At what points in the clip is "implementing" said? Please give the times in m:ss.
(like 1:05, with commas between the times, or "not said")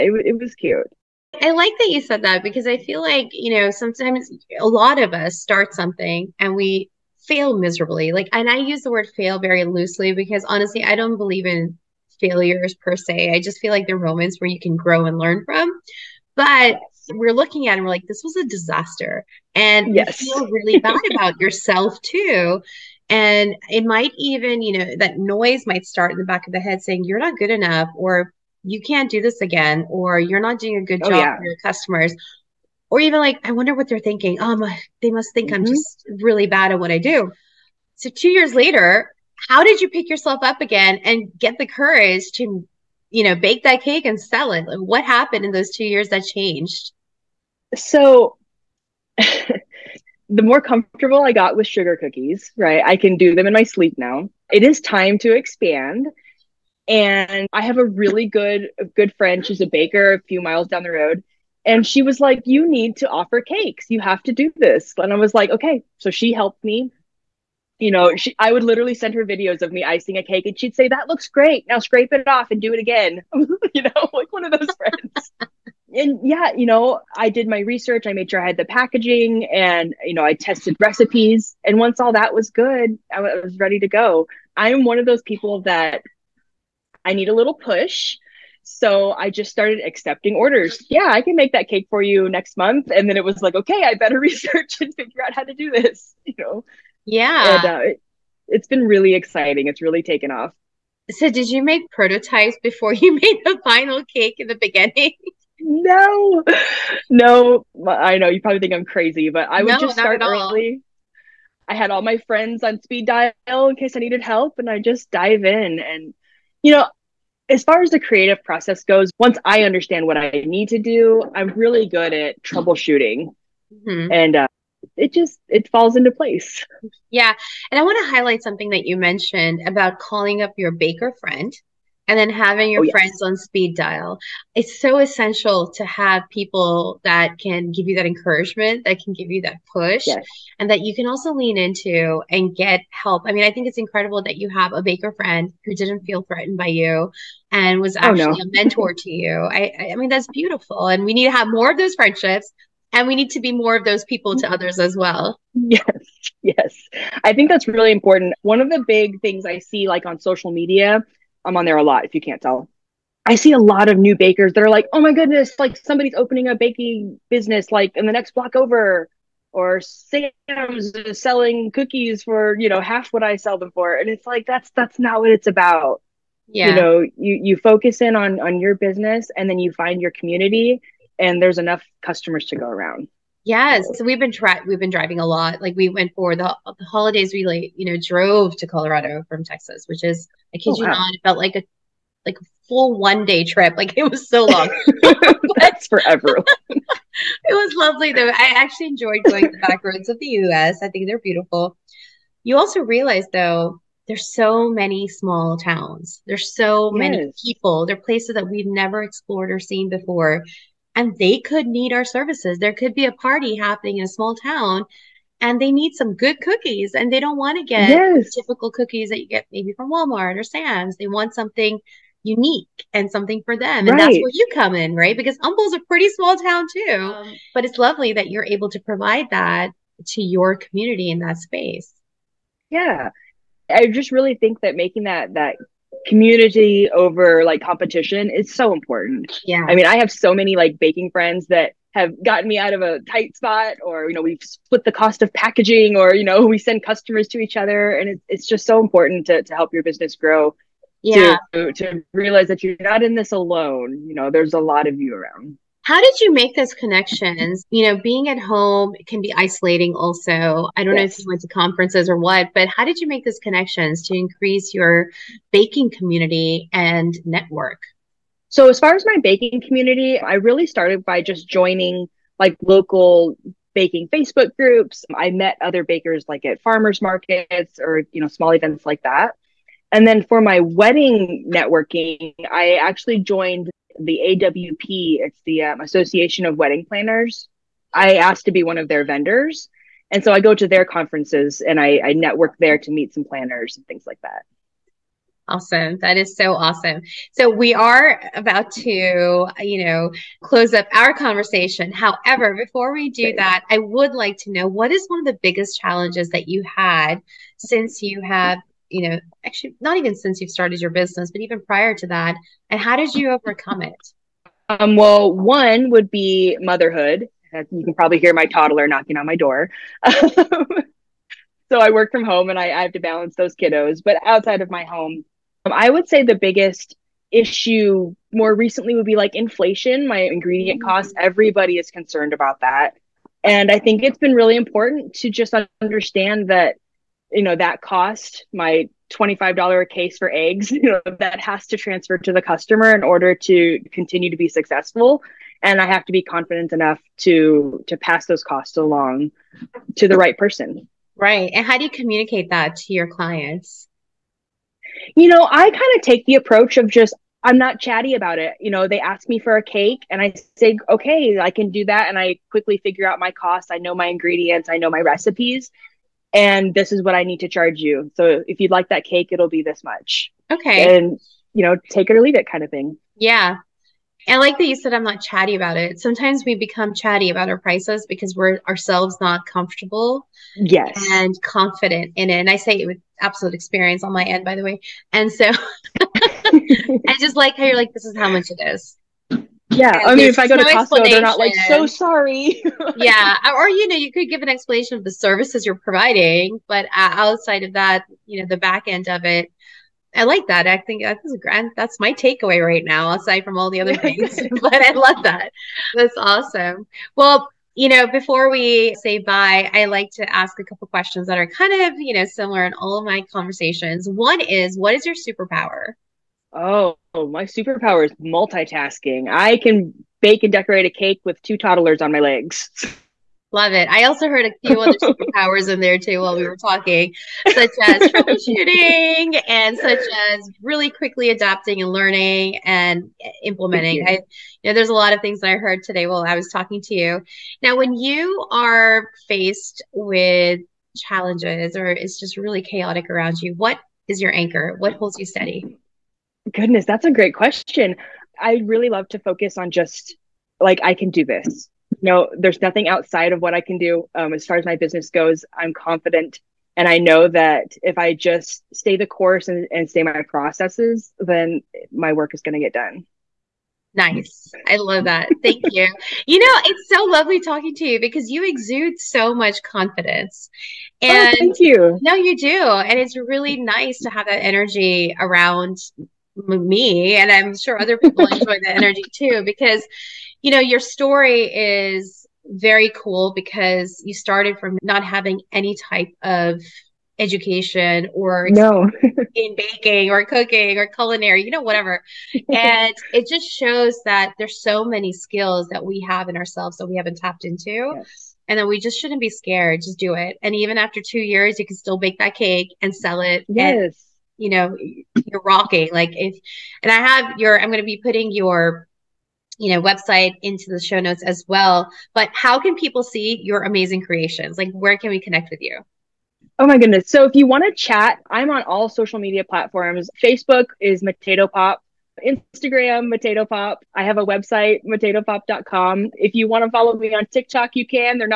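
7:13.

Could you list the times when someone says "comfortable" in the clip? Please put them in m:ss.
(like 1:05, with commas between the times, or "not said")
0:50, 6:19.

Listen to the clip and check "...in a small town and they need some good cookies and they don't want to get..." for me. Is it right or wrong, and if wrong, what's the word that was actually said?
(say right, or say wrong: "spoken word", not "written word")
right.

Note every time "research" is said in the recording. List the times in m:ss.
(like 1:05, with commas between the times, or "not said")
1:17, 1:34.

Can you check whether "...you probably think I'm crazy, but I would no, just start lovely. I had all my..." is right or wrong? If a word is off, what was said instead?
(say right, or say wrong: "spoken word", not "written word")
wrong: "early", not "lovely".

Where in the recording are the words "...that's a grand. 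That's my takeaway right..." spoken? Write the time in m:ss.
6:41.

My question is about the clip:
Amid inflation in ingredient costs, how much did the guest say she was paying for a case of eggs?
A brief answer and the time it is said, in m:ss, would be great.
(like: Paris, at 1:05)
$25, at 5:39.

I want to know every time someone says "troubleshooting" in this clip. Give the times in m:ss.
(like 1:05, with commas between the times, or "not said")
2:02, 7:08.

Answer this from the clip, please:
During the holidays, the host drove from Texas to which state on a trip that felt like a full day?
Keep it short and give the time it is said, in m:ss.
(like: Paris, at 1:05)
Colorado, at 3:08.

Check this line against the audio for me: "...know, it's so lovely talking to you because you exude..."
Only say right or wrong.
right.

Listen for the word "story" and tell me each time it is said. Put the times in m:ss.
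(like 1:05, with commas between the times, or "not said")
8:00.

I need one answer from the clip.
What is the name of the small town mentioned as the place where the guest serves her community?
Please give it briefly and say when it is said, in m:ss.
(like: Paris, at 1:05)
Humble, at 3:45.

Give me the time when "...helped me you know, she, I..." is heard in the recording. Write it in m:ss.
1:06.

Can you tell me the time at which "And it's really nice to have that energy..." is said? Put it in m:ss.
7:52.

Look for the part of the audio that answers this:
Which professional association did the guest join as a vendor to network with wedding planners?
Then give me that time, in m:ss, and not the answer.
4:45.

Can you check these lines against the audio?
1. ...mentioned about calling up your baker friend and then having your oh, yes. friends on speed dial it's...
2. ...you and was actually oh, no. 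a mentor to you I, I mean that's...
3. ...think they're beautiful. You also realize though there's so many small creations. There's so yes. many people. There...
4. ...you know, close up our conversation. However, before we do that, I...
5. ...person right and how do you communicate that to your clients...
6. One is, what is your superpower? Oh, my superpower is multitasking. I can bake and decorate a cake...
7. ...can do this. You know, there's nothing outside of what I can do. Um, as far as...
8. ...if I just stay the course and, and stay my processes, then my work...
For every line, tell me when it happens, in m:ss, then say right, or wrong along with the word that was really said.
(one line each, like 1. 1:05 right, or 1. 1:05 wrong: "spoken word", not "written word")
1. 2:08 right
2. 2:26 right
3. 3:20 wrong: "towns", not "creations"
4. 4:59 right
5. 5:50 right
6. 6:54 right
7. 7:30 right
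8. 7:37 right.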